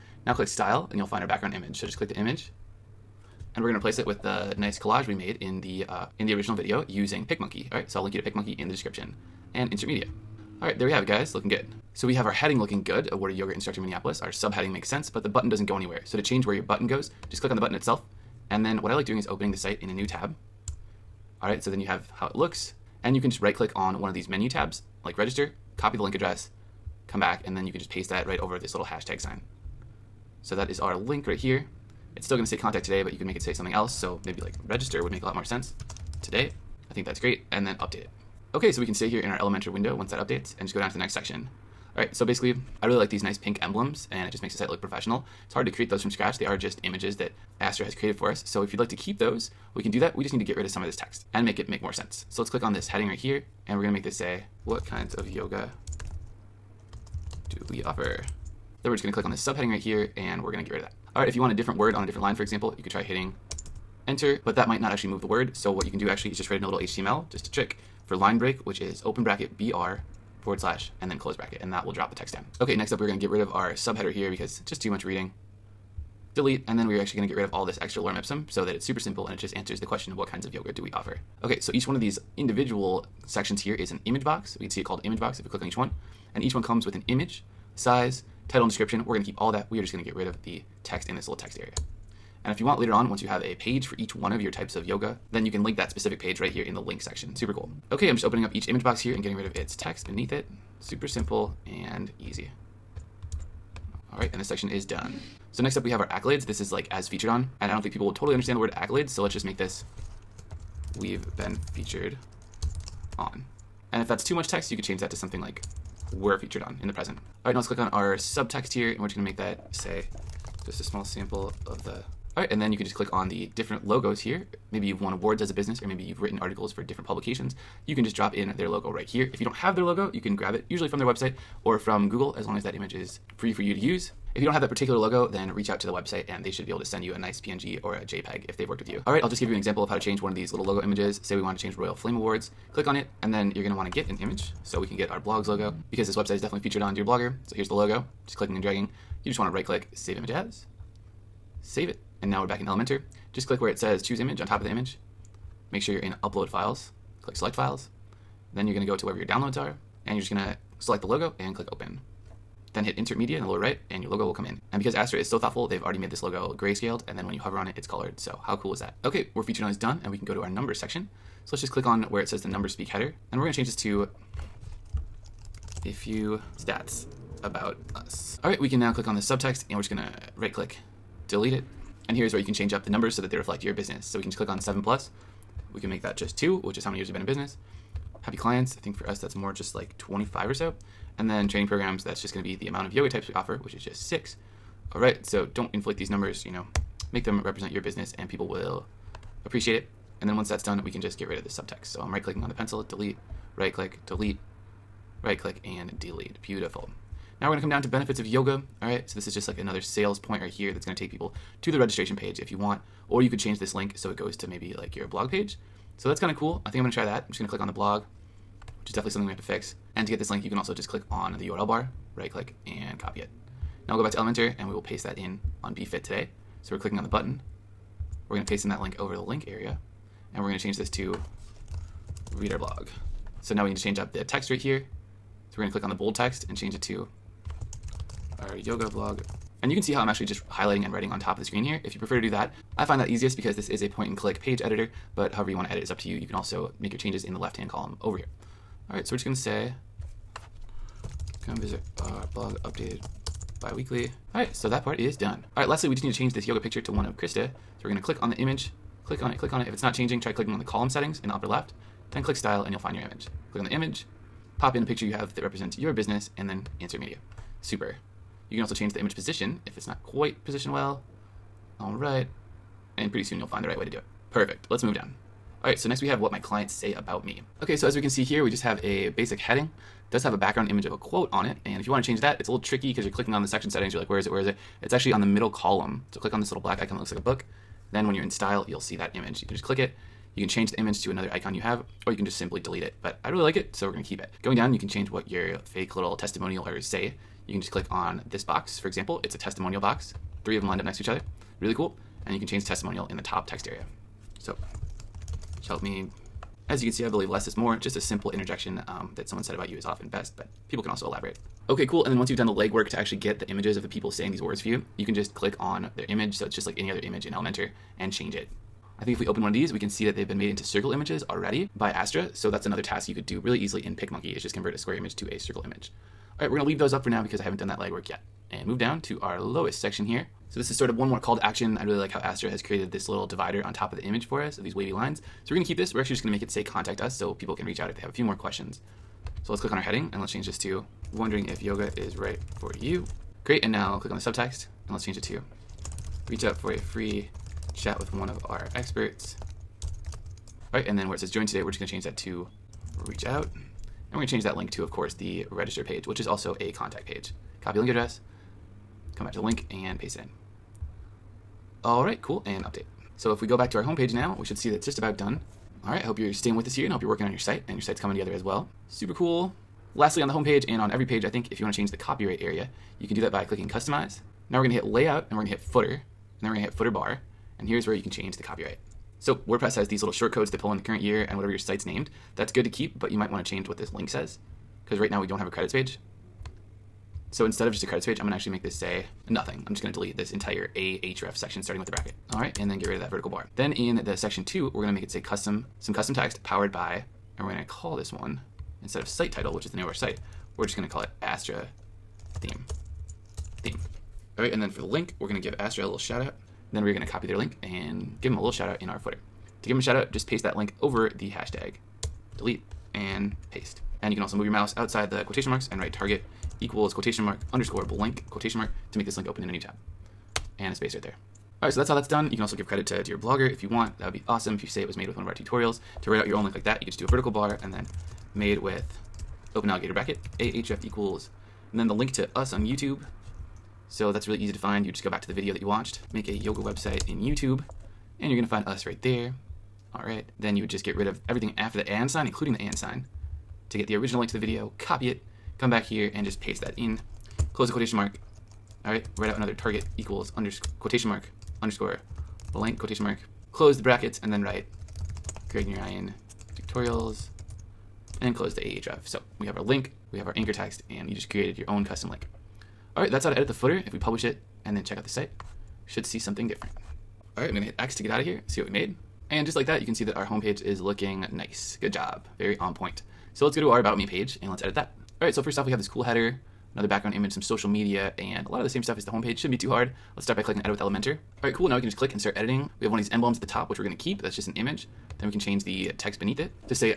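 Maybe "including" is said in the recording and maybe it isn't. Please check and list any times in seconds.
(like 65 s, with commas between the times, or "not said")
442 s.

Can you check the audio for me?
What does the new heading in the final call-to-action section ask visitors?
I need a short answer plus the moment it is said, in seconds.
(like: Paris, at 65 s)
Wondering if yoga is right for you, at 341 s.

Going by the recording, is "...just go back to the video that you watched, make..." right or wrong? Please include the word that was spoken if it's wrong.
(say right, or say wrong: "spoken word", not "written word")
right.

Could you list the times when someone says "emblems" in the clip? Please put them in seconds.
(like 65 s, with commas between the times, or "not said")
43 s, 483 s.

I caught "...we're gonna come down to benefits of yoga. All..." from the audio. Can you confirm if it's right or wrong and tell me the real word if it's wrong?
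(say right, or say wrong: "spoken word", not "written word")
right.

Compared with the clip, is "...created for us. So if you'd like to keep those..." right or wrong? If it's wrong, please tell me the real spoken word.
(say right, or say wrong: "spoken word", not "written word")
right.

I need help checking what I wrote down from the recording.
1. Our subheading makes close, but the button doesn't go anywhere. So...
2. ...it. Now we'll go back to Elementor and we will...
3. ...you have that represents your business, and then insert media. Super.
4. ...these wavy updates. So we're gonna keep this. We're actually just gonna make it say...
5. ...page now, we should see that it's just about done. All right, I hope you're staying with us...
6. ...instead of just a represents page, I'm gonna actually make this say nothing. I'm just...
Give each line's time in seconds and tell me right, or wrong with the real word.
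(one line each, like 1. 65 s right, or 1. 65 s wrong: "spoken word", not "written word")
1. 14 s wrong: "sense", not "close"
2. 223 s right
3. 265 s right
4. 334 s wrong: "lines", not "updates"
5. 363 s right
6. 387 s wrong: "credits", not "represents".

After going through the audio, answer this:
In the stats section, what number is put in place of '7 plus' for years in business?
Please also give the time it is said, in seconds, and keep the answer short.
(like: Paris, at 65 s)
2, at 186 s.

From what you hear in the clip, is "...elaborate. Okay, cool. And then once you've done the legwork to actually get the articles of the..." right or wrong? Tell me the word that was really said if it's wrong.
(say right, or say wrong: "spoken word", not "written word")
wrong: "images", not "articles".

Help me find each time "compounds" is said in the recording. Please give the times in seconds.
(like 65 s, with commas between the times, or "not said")
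not said.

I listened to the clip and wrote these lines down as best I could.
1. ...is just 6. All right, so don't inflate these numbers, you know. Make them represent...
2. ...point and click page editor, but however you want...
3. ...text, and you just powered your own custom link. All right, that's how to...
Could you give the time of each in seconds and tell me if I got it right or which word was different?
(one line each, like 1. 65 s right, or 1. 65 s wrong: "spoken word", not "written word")
1. 193 s right
2. 243 s right
3. 460 s wrong: "created", not "powered".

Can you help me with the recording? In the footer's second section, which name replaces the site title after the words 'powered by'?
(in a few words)
Astra theme.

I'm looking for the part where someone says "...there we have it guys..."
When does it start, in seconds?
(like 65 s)
10 s.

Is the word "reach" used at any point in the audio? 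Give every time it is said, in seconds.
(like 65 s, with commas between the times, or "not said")
135 s, 337 s, 346 s, 353 s.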